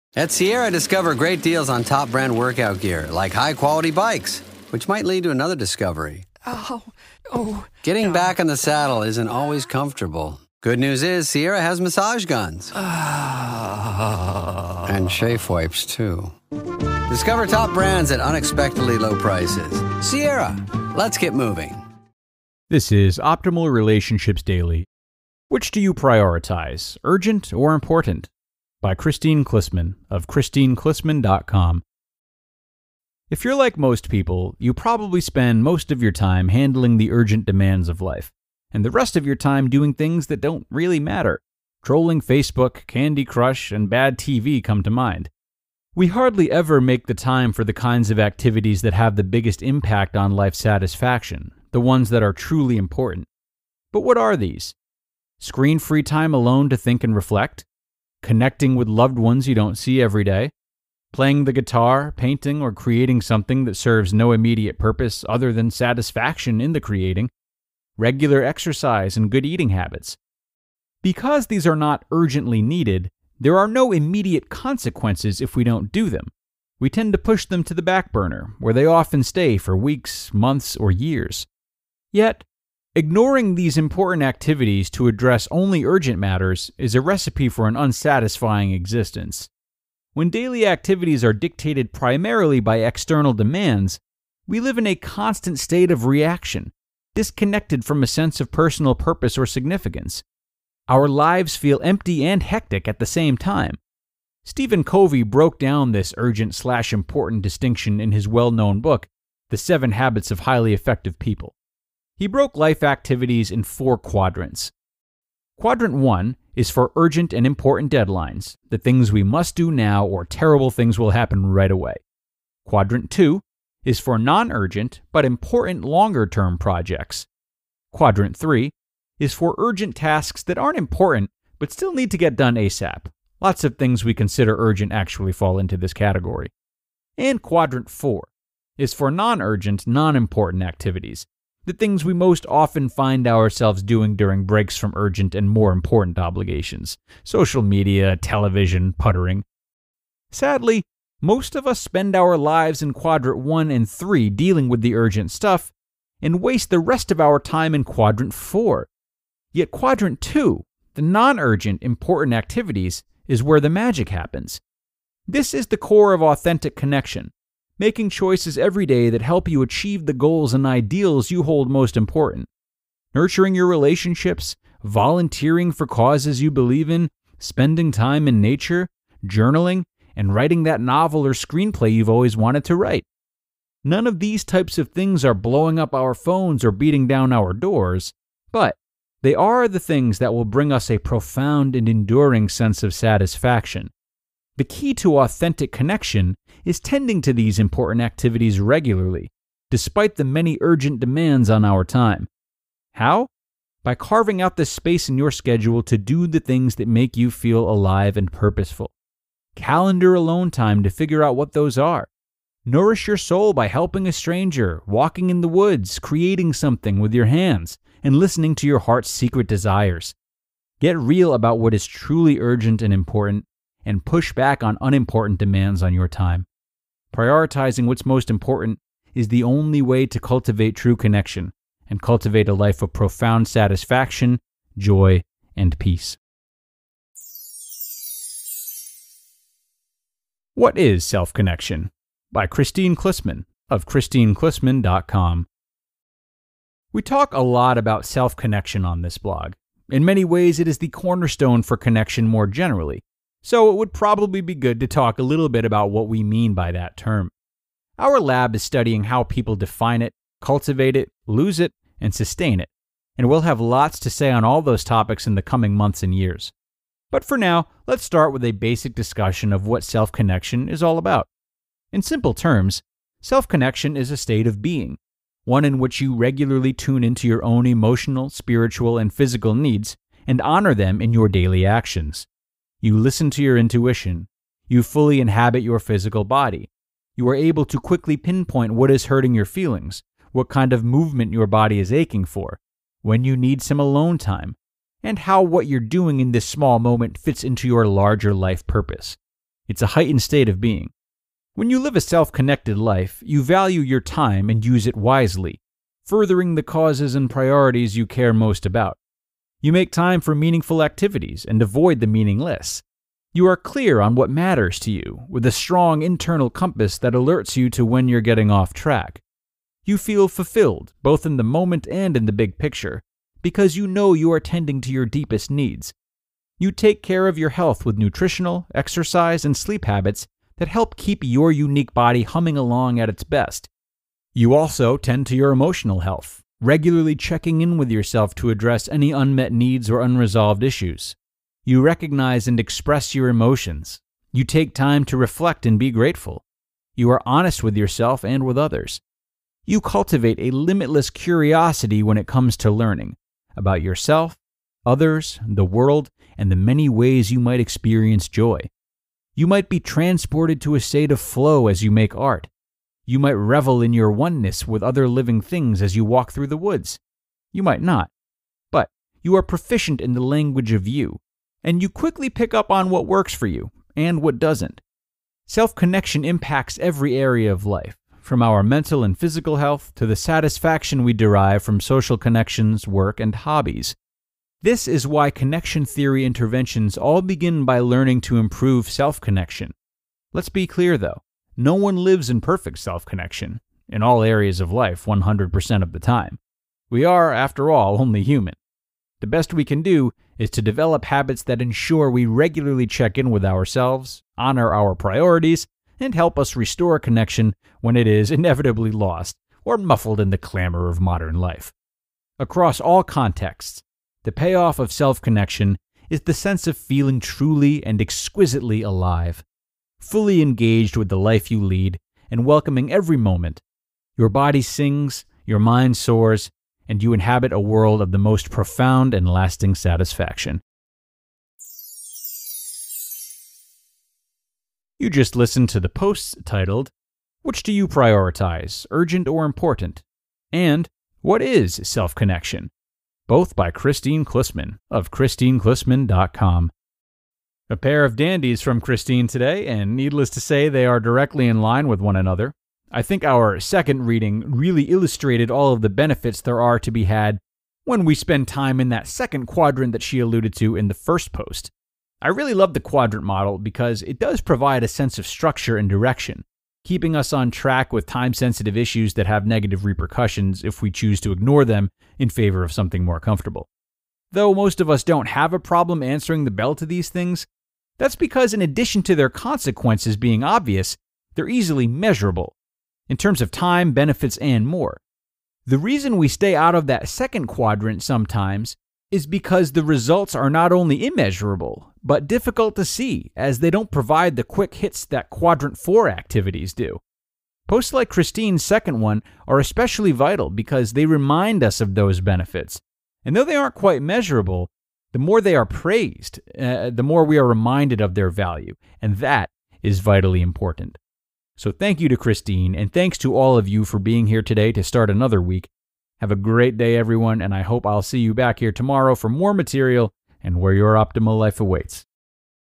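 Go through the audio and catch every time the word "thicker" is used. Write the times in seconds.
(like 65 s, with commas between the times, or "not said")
not said.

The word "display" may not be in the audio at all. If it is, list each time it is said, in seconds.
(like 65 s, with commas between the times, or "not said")
not said.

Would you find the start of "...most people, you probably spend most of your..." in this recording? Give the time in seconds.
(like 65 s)
33 s.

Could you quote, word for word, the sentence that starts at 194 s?
The key to authentic connection is tending to these important activities regularly, despite the many urgent demands on our time.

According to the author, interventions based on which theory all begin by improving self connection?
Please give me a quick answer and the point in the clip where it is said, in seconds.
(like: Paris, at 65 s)
connection theory, at 385 s.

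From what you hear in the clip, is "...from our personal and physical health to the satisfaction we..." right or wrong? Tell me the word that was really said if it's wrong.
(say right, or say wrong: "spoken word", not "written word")
wrong: "mental", not "personal".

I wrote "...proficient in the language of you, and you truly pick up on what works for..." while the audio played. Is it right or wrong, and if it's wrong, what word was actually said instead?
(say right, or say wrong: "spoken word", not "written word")
wrong: "quickly", not "truly".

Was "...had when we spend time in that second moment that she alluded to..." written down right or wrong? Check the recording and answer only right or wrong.
wrong.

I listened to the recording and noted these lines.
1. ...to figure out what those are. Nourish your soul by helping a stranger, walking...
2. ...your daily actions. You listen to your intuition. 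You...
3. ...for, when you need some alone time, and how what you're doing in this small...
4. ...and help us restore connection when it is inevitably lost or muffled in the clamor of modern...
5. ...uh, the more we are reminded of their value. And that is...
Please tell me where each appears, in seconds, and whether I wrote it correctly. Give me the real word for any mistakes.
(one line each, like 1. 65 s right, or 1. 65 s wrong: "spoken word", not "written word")
1. 210 s right
2. 281 s right
3. 292 s right
4. 405 s right
5. 506 s right.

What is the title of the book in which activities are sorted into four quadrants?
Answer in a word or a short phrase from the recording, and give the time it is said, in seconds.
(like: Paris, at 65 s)
The Seven Habits of Highly Effective People, at 109 s.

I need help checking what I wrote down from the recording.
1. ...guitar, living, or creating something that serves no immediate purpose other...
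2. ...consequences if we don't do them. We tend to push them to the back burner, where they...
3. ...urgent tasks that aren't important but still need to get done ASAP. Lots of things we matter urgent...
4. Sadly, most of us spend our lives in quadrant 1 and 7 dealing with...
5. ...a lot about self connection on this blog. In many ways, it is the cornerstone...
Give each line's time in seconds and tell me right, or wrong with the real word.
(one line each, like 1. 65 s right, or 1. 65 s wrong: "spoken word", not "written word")
1. 61 s wrong: "painting", not "living"
2. 74 s right
3. 129 s wrong: "consider", not "matter"
4. 150 s wrong: "3", not "7"
5. 247 s right.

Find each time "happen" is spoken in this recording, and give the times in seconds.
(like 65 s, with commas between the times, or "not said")
121 s, 164 s.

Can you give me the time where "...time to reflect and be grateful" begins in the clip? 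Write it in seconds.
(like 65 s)
344 s.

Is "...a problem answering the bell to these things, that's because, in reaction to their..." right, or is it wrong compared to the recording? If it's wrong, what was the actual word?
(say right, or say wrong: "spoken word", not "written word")
wrong: "addition", not "reaction".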